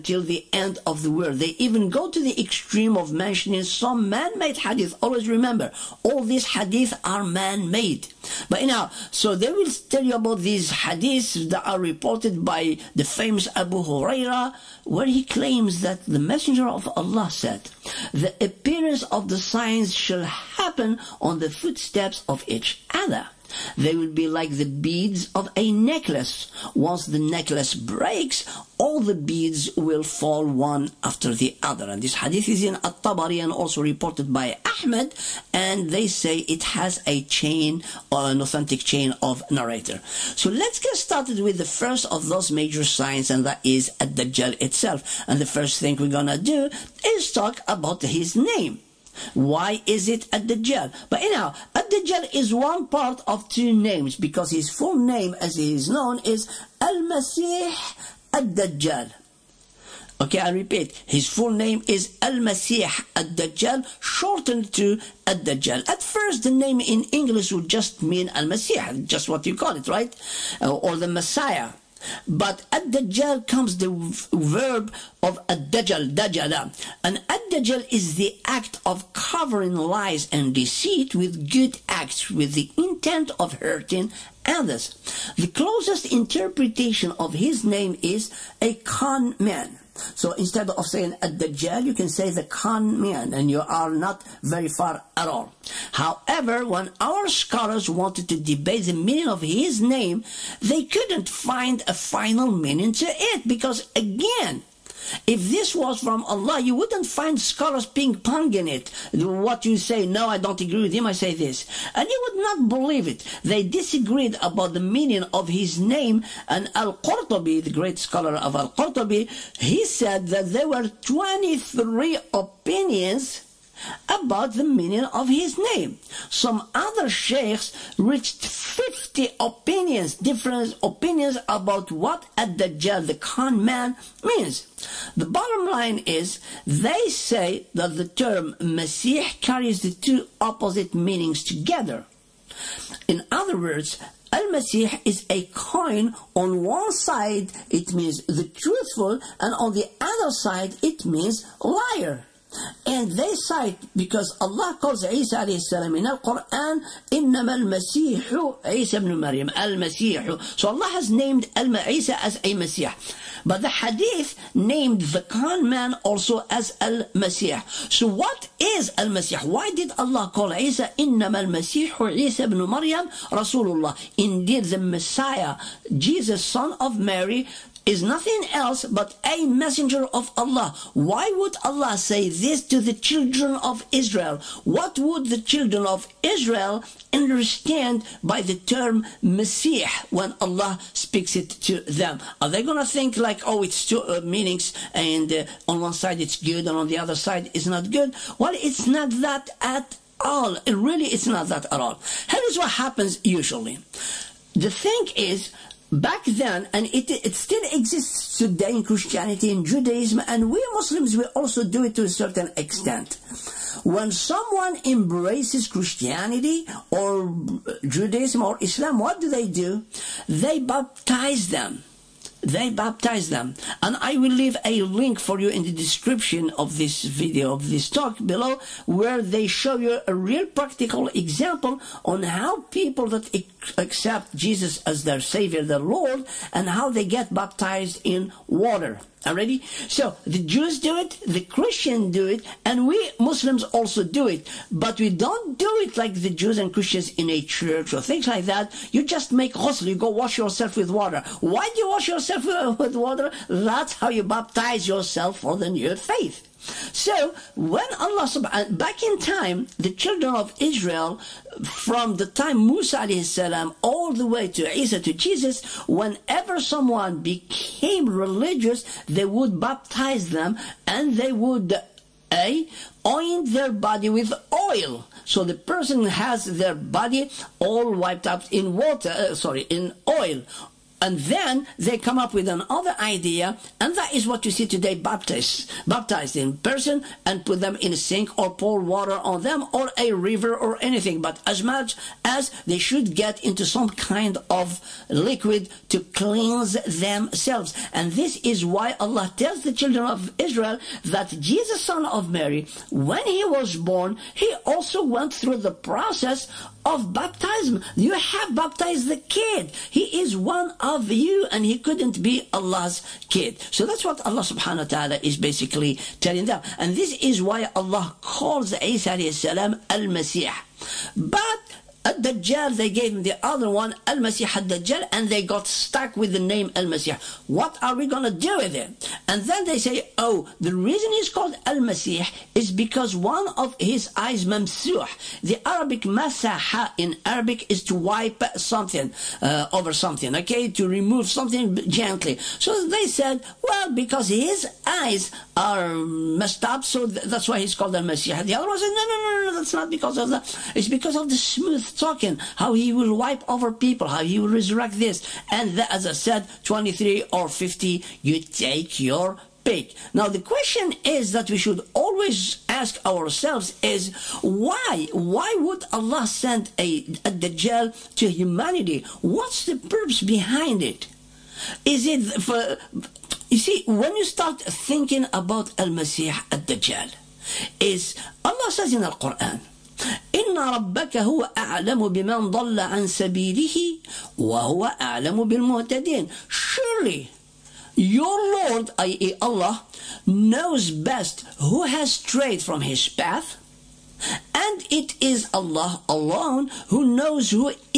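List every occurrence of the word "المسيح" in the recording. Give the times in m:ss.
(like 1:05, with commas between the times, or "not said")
2:37, 2:51.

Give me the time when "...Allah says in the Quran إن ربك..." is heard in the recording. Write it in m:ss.
6:18.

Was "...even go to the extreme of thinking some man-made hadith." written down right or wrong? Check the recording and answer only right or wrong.
wrong.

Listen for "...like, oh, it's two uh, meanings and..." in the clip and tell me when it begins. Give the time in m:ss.
3:13.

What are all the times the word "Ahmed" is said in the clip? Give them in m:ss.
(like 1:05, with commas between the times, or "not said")
0:34.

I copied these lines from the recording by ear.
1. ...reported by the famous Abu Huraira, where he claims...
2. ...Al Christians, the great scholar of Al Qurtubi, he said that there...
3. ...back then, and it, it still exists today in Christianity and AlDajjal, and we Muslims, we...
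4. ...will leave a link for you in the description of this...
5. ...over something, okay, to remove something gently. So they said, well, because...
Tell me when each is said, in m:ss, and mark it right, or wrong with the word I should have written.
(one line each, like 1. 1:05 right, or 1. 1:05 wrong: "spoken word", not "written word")
1. 0:11 right
2. 1:56 wrong: "Qurtubi", not "Christians"
3. 3:25 wrong: "Judaism", not "AlDajjal"
4. 3:44 right
5. 5:39 right.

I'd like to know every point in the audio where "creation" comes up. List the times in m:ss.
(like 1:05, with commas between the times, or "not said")
not said.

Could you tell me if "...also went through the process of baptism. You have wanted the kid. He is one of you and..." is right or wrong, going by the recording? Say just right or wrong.
wrong.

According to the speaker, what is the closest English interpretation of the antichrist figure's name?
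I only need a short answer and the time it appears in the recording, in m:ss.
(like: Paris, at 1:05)
A con man, at 1:28.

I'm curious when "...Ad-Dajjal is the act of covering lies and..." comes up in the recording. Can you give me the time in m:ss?
1:17.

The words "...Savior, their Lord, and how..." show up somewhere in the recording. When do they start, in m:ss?
3:55.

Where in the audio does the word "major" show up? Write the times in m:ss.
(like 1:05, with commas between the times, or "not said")
0:42.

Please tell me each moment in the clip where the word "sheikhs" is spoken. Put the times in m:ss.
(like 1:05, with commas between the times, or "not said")
2:07.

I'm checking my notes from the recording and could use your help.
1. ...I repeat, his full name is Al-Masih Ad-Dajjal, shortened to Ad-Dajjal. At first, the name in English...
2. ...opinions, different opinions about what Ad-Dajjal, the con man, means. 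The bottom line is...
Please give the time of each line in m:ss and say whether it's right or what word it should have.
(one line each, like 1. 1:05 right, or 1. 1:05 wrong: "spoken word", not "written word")
1. 1:00 right
2. 2:09 right.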